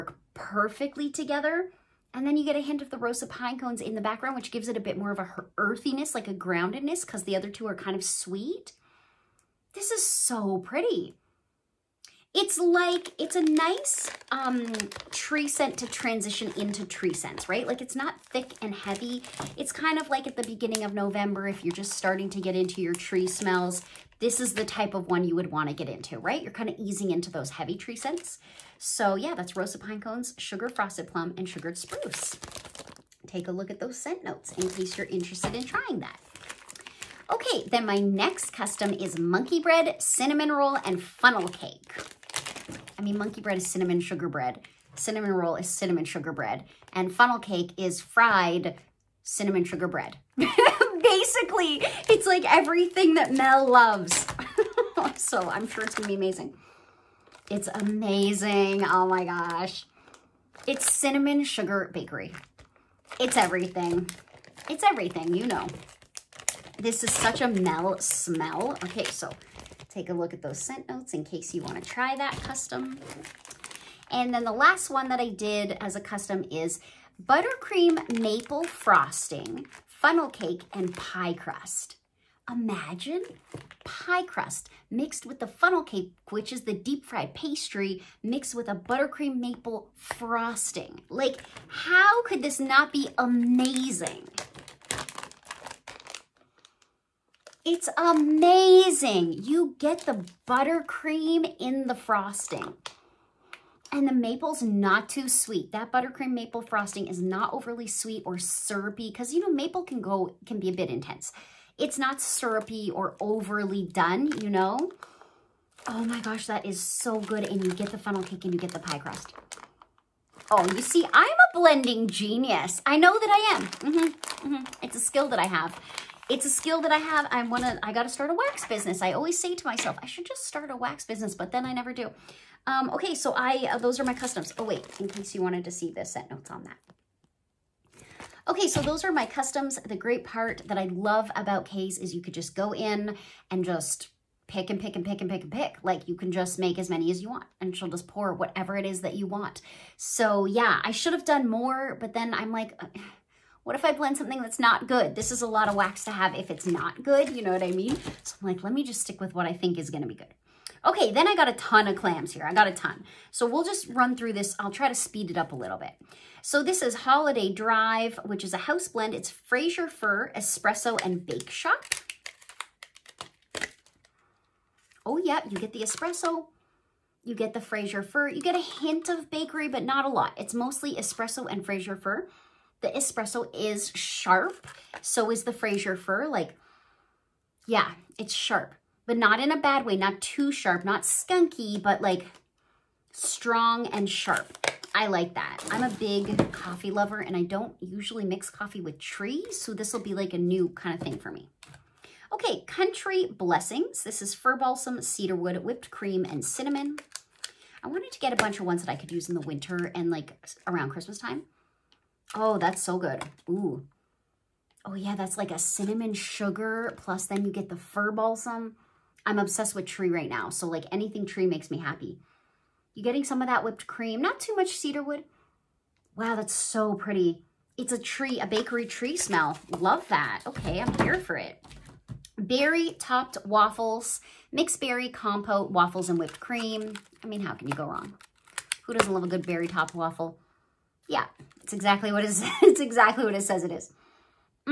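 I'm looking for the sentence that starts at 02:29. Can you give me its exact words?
So yeah, I should have done more, but then I'm like, what if I blend something that's not good?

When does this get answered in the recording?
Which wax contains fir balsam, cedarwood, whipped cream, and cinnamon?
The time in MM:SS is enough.
03:22.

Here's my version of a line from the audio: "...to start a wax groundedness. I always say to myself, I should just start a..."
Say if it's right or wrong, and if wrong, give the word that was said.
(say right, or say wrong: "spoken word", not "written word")
wrong: "business", not "groundedness".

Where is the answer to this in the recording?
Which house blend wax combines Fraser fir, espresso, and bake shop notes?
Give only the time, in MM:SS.
02:46.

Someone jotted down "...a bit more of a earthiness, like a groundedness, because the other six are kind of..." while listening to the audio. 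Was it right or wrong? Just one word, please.
wrong.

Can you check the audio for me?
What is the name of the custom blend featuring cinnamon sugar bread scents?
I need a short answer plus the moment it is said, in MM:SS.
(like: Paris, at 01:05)
Cinnamon Sugar Bakery, at 01:00.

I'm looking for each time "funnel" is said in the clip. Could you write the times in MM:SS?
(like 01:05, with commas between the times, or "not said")
00:41, 00:47, 01:19, 01:25, 01:57.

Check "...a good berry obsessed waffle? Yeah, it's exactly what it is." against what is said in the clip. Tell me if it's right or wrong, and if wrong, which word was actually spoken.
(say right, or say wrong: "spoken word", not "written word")
wrong: "topped", not "obsessed".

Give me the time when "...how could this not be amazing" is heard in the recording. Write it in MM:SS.
01:31.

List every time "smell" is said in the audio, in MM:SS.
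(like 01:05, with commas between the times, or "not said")
00:23, 01:07, 03:49.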